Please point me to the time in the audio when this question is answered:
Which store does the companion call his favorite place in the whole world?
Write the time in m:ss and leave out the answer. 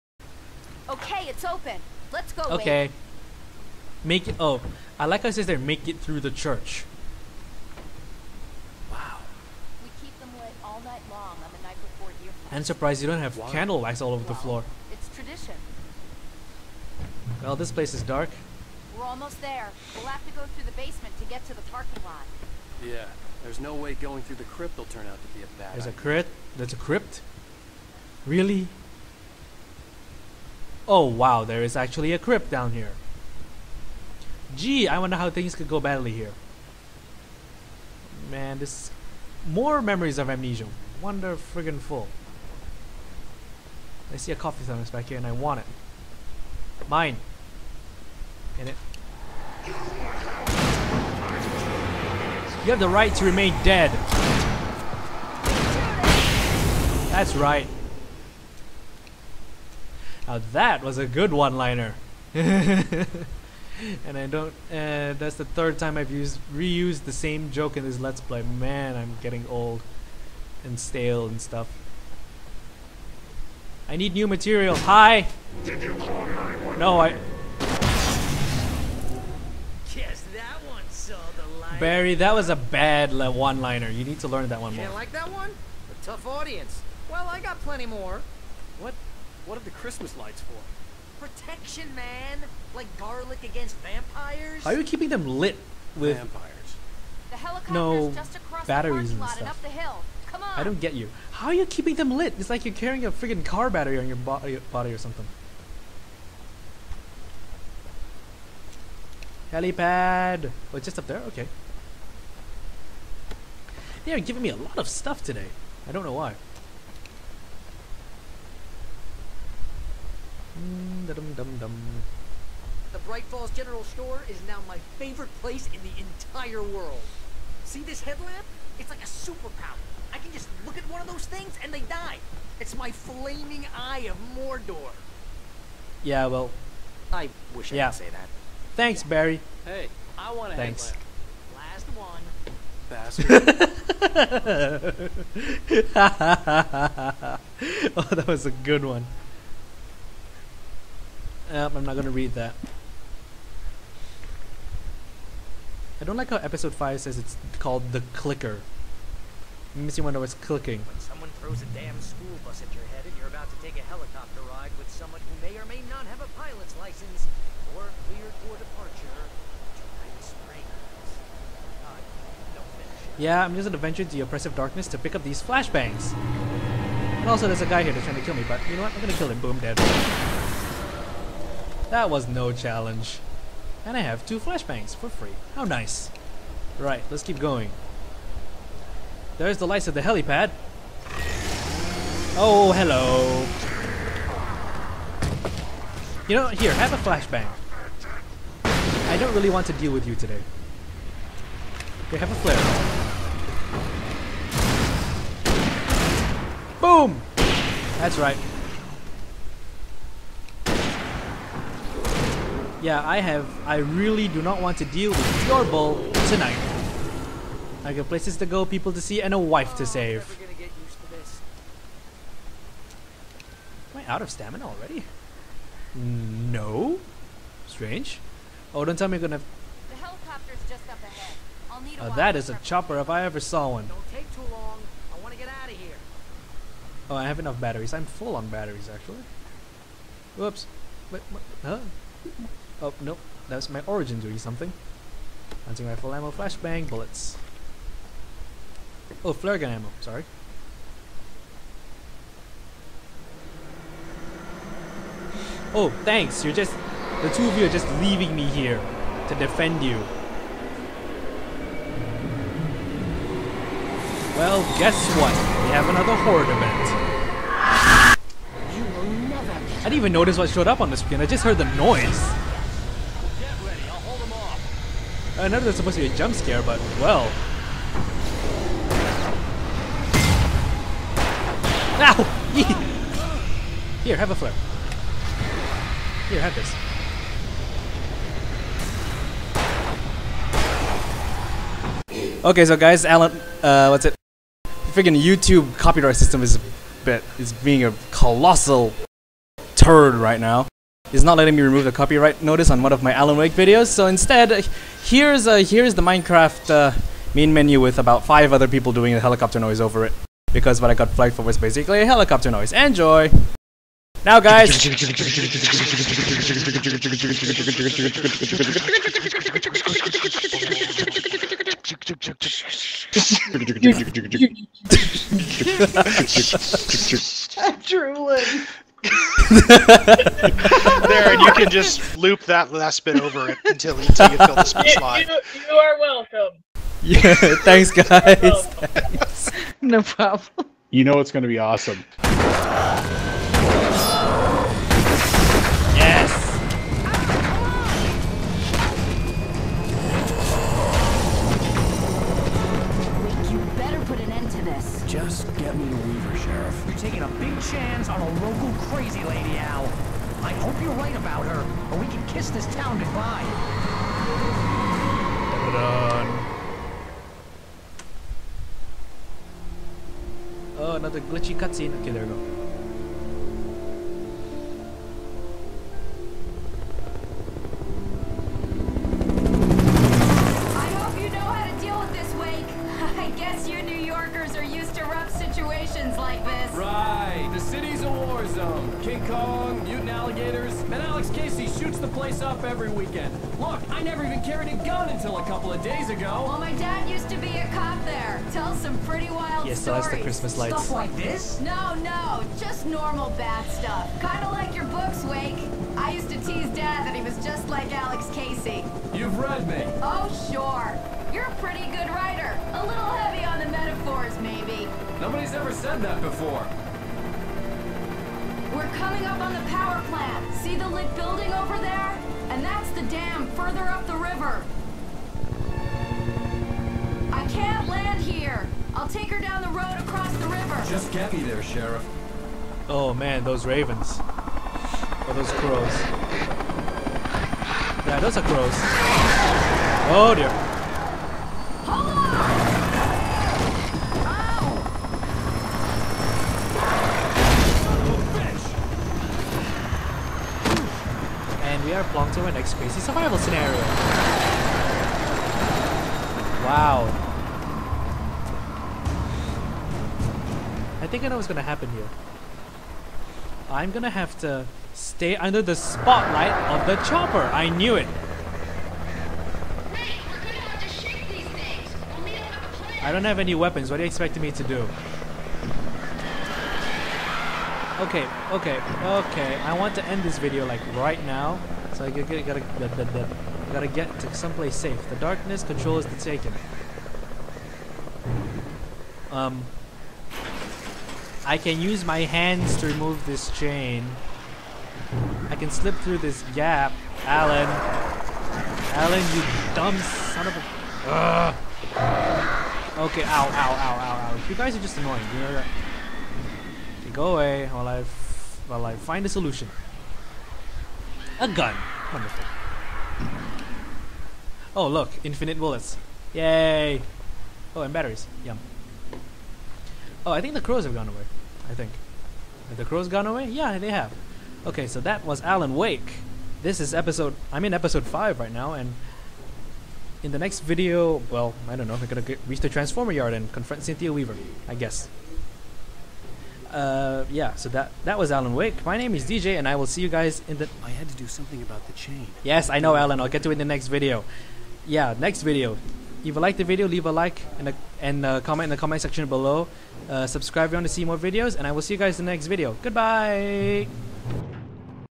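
2:02.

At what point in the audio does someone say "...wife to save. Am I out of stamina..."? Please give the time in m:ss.
3:39.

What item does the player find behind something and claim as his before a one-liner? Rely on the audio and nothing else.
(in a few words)
Coffee thermos.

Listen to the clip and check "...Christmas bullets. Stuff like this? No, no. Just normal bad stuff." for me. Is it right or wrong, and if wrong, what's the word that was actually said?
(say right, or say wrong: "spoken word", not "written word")
wrong: "lights", not "bullets".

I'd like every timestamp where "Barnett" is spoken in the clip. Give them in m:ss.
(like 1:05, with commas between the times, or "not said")
not said.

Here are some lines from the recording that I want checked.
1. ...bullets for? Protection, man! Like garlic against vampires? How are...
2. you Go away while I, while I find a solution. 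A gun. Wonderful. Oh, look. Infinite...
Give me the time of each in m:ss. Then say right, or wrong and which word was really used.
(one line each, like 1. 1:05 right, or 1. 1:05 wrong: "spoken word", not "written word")
1. 1:30 wrong: "lights", not "bullets"
2. 8:25 right.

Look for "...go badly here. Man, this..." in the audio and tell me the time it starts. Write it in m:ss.
0:35.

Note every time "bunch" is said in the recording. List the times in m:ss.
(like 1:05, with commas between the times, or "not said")
not said.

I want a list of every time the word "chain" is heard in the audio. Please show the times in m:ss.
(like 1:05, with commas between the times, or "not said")
8:13, 9:01.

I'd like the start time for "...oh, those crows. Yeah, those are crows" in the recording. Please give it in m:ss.
7:14.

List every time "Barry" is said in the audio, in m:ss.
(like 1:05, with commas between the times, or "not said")
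1:21, 2:19.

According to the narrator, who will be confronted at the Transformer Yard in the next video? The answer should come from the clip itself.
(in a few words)
Cynthia Weaver.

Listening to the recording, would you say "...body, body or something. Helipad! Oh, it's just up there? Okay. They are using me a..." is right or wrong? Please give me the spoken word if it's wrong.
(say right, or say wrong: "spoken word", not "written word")
wrong: "giving", not "using".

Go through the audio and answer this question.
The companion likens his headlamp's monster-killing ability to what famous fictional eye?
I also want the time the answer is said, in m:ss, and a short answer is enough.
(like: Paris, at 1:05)
Eye of Mordor, at 2:13.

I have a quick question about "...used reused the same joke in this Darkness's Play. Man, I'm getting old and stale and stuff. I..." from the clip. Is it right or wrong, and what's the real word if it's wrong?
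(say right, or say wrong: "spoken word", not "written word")
wrong: "Let", not "Darkness".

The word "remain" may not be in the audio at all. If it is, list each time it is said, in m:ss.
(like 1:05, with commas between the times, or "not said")
0:53.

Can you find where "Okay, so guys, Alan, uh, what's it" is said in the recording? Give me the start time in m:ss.
4:52.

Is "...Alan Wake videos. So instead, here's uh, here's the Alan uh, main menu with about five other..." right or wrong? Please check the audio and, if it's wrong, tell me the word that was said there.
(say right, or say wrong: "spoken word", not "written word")
wrong: "Minecraft", not "Alan".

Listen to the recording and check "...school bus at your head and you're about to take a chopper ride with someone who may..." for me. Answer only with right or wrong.
wrong.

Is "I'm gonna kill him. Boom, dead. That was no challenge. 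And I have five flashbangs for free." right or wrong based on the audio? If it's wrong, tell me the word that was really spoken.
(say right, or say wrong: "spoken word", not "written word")
wrong: "two", not "five".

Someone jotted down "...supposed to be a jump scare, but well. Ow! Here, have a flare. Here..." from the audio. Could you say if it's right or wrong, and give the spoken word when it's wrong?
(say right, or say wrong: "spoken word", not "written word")
right.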